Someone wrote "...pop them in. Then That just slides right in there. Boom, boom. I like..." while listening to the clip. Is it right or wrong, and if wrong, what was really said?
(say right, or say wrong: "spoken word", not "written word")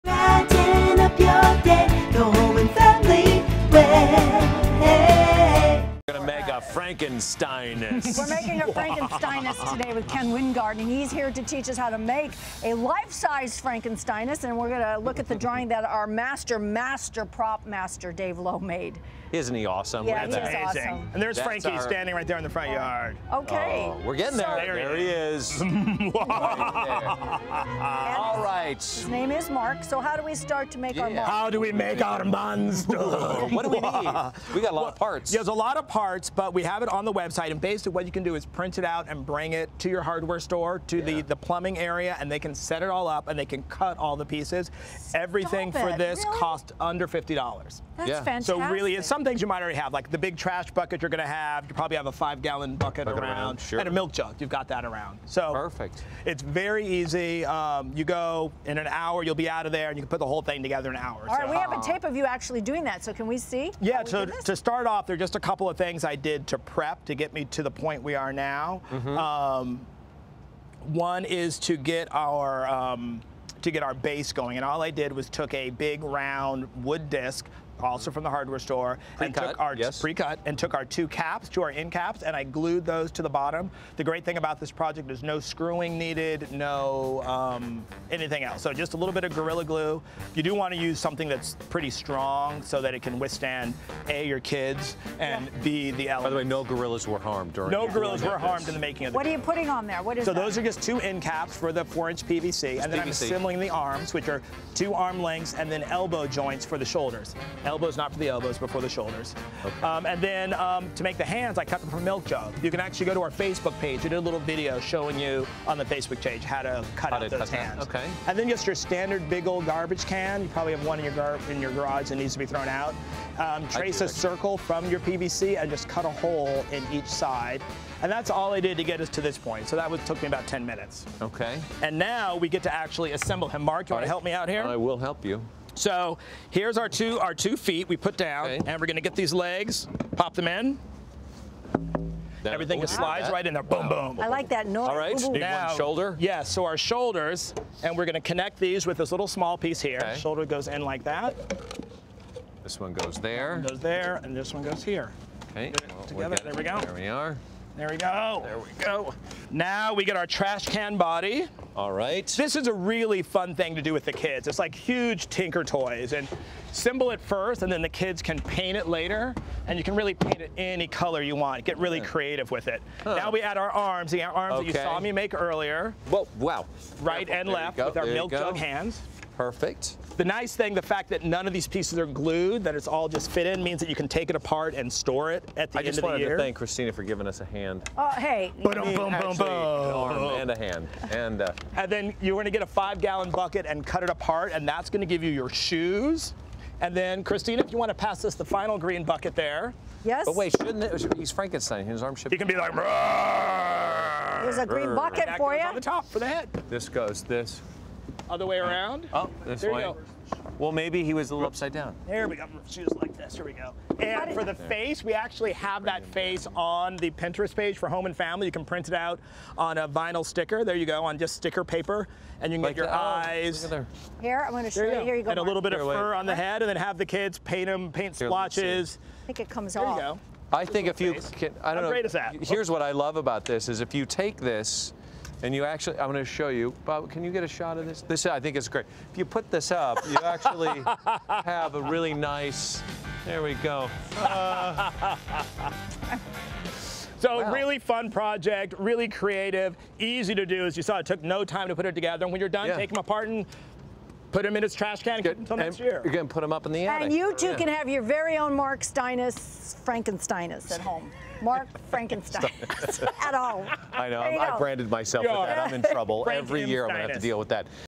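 wrong: "Everything", not "That".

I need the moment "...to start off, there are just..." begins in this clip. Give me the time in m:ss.
1:04.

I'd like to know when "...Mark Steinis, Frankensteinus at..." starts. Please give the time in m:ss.
4:18.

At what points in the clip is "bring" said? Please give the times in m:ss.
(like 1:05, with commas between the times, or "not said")
0:39.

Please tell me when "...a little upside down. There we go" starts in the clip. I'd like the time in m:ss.
3:31.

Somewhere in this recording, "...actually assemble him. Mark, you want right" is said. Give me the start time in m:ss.
2:12.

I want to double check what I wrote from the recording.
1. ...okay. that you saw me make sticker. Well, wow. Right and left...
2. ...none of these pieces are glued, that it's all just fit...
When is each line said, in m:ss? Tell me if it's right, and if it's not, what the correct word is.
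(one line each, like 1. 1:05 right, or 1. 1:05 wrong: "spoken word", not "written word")
1. 2:54 wrong: "earlier", not "sticker"
2. 3:01 right.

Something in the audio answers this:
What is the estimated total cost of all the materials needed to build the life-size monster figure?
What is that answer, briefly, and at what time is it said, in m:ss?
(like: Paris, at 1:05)
under $50, at 0:46.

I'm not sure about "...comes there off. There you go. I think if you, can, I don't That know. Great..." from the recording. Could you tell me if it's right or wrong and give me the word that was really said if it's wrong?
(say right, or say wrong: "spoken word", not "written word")
wrong: "How", not "That".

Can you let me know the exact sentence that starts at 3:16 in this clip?
And then, Christina, if you want to pass us the final green bucket there.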